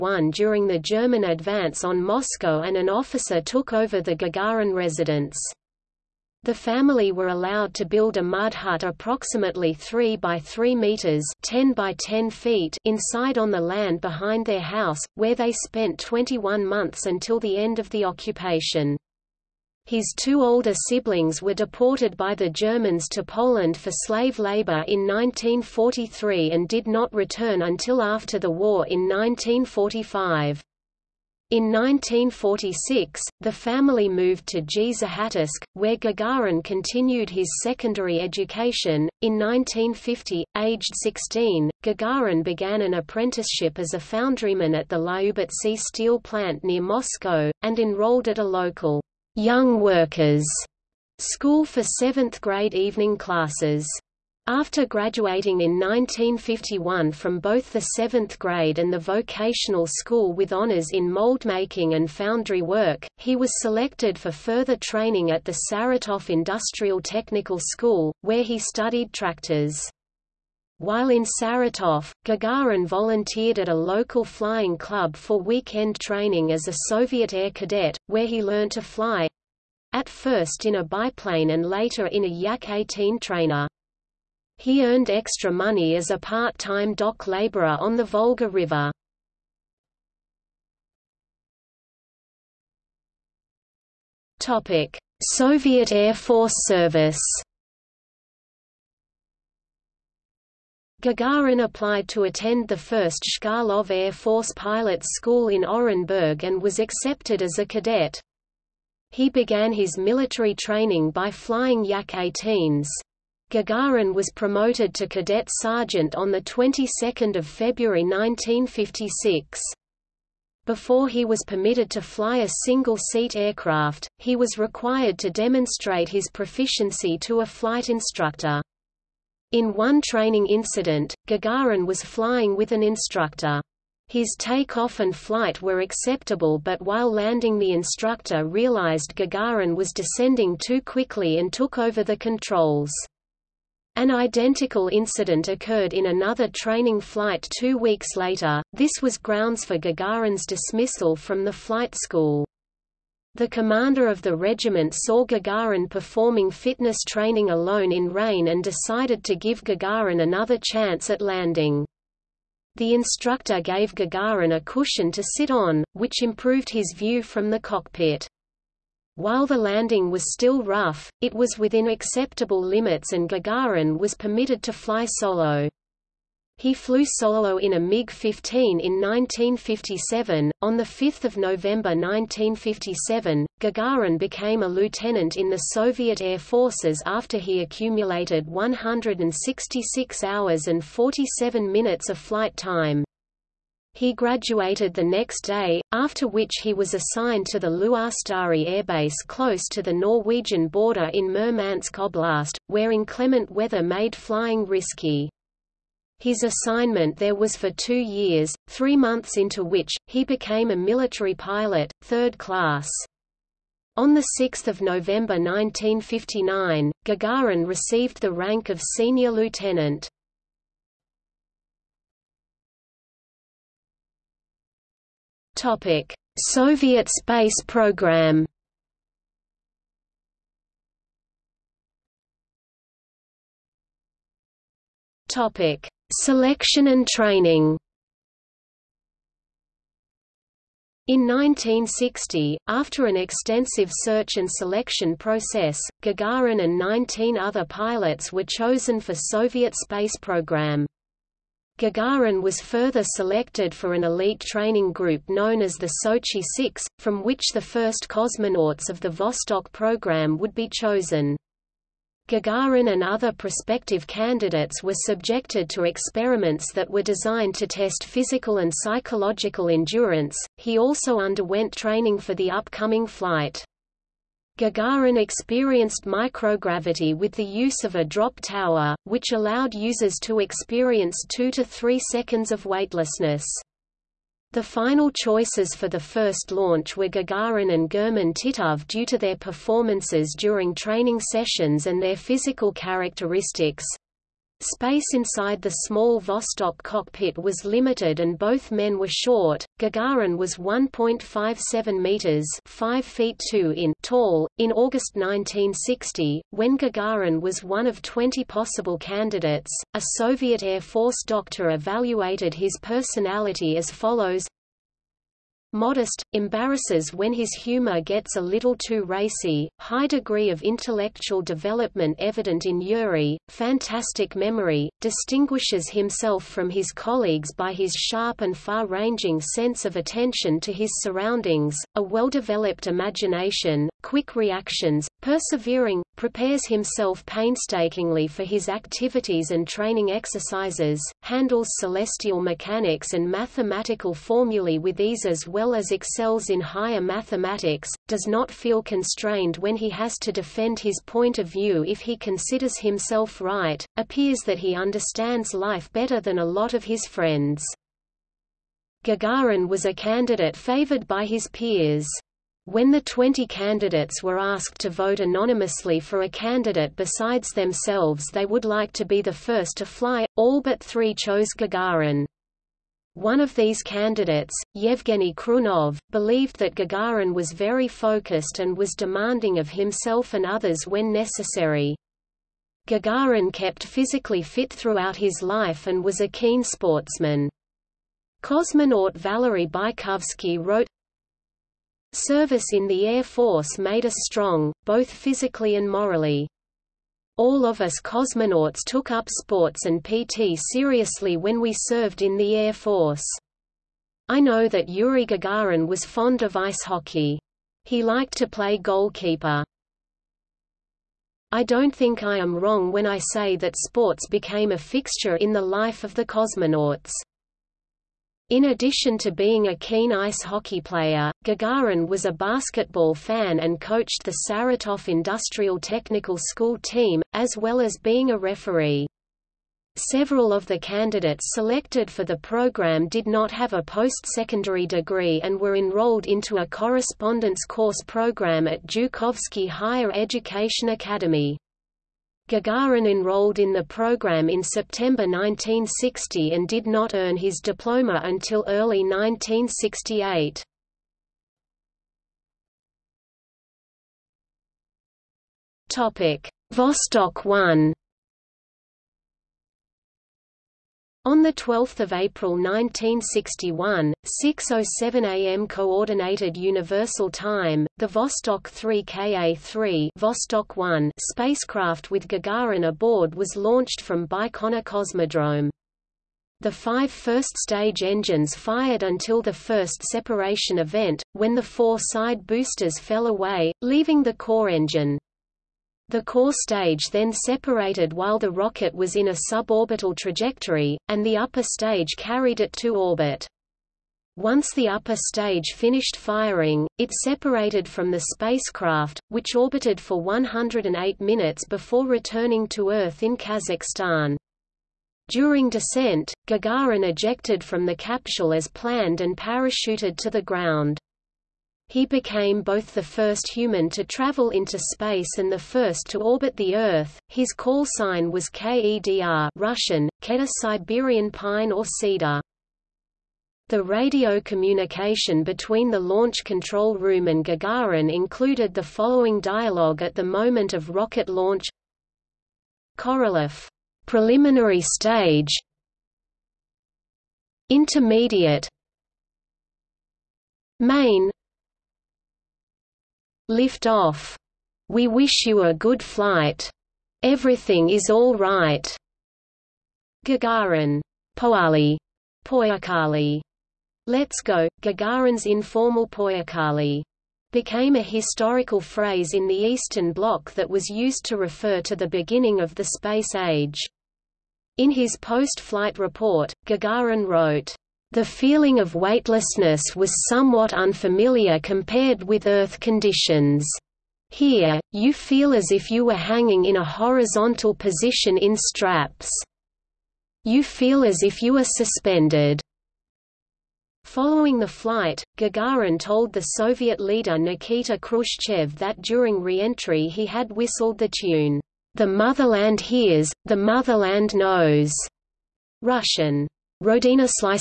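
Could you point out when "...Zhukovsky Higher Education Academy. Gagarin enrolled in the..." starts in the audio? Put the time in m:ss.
7:18.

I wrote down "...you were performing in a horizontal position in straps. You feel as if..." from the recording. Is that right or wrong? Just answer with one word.
wrong.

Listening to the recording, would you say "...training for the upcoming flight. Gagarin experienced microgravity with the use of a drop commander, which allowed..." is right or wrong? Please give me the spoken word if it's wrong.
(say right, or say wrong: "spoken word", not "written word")
wrong: "tower", not "commander".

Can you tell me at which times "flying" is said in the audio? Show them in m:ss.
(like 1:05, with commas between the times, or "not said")
1:14, 1:51, 2:12, 3:24.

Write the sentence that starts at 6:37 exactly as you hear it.
All of us cosmonauts took up sports and PT seriously when we served in the Air Force.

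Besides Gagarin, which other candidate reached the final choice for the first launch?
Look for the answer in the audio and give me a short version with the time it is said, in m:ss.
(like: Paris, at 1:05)
German Titov, at 4:47.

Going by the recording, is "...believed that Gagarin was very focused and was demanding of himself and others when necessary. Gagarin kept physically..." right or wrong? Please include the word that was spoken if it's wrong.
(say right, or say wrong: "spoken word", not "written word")
right.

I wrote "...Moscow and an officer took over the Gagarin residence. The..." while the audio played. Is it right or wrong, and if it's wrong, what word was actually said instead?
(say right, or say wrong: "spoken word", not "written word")
right.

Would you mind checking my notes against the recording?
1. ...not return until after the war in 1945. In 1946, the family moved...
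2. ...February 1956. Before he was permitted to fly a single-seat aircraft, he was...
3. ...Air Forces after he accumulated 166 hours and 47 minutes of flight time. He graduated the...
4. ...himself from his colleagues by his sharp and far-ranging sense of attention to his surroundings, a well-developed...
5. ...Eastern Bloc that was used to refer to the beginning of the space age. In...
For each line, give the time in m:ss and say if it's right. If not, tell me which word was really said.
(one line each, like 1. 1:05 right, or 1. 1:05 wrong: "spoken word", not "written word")
1. 0:26 right
2. 1:57 right
3. 3:06 right
4. 5:25 right
5. 9:19 right.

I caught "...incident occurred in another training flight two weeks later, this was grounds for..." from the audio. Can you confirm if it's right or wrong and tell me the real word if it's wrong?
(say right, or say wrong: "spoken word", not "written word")
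right.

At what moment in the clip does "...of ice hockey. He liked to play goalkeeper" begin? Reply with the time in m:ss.
6:46.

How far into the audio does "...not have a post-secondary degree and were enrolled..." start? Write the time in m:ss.
7:13.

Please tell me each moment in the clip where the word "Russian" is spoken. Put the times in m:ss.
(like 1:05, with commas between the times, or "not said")
8:39, 9:55.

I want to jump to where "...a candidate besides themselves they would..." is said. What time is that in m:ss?
6:06.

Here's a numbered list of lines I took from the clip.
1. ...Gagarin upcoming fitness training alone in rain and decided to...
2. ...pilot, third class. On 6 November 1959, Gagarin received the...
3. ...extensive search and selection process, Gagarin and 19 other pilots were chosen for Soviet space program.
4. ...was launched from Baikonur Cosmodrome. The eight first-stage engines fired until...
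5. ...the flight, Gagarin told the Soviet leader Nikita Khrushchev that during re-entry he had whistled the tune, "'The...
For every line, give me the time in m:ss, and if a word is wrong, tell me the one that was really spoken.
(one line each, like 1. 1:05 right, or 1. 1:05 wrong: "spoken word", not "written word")
1. 2:35 wrong: "performing", not "upcoming"
2. 3:31 right
3. 4:03 right
4. 7:53 wrong: "five", not "eight"
5. 9:44 right.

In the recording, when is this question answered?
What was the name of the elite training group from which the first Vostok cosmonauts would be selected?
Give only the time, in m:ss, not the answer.
4:16.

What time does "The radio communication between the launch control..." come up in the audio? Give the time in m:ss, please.
8:43.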